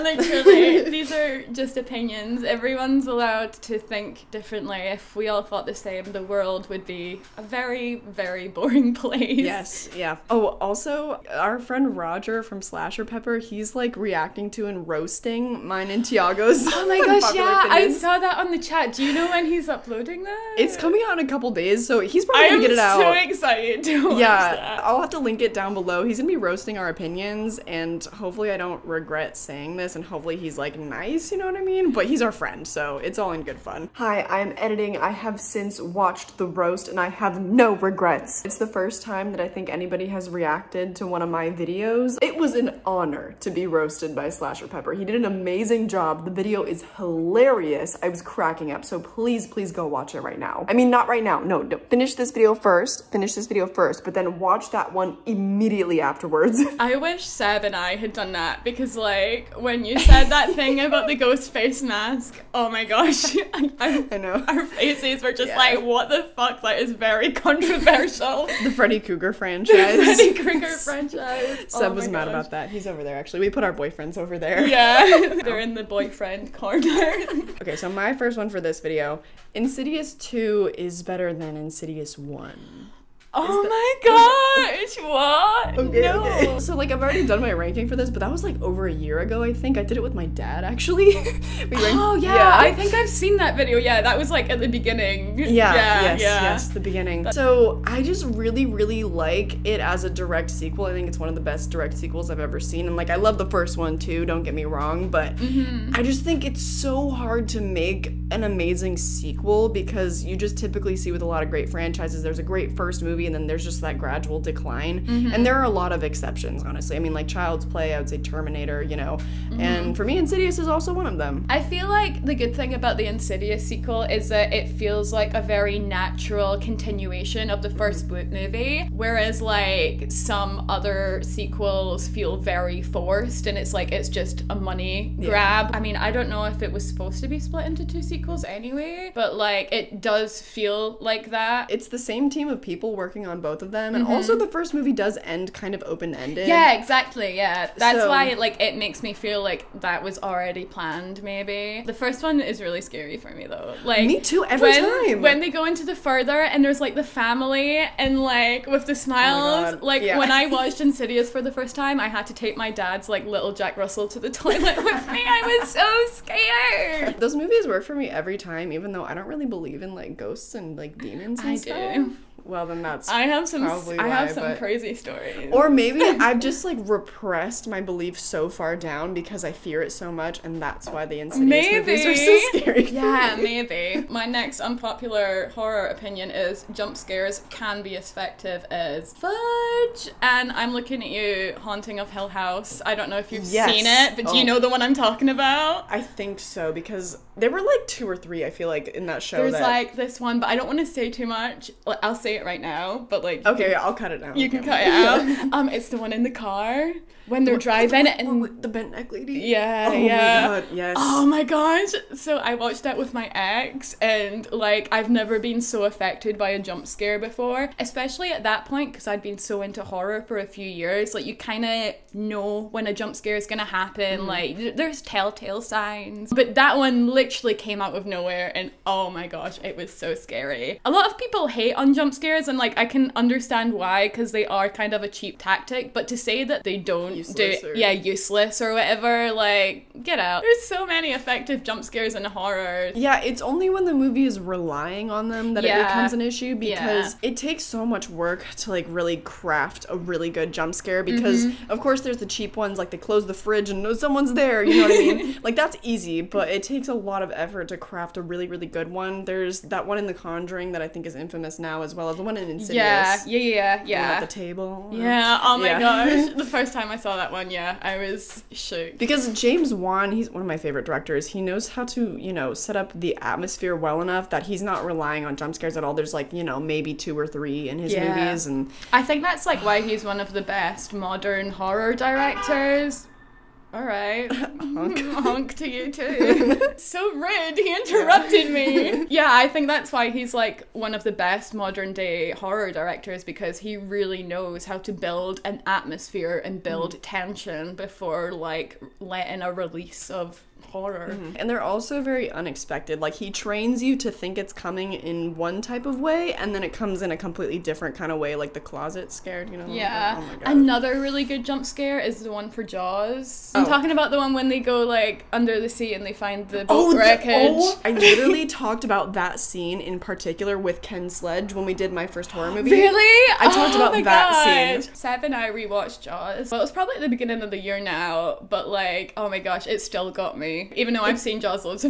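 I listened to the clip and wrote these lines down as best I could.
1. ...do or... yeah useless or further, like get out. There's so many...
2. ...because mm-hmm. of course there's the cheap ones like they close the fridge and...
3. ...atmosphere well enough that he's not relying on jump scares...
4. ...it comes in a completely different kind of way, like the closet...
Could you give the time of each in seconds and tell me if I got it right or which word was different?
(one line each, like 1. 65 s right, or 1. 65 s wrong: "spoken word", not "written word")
1. 237 s wrong: "whatever", not "further"
2. 251 s right
3. 273 s right
4. 306 s right.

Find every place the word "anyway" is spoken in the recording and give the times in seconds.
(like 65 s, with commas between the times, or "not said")
138 s.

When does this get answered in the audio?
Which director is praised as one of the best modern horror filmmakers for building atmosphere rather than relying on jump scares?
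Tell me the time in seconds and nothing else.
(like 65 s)
269 s.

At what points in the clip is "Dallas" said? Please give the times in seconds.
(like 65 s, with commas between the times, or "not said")
not said.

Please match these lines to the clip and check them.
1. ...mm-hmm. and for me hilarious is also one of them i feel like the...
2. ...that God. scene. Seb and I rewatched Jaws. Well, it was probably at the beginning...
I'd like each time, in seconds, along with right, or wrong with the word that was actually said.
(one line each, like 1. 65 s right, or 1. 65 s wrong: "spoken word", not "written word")
1. 119 s wrong: "insidious", not "hilarious"
2. 324 s right.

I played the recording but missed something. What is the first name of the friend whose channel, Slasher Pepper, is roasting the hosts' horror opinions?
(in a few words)
Roger.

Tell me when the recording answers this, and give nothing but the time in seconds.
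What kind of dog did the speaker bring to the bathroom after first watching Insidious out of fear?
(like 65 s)
163 s.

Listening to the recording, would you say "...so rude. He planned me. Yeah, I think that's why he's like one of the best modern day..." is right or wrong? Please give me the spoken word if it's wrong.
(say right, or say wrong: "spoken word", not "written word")
wrong: "interrupted", not "planned".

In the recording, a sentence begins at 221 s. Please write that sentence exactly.
Like you kind of know when a jump scare is gonna happen.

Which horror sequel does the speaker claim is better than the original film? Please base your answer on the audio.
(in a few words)
Insidious 2.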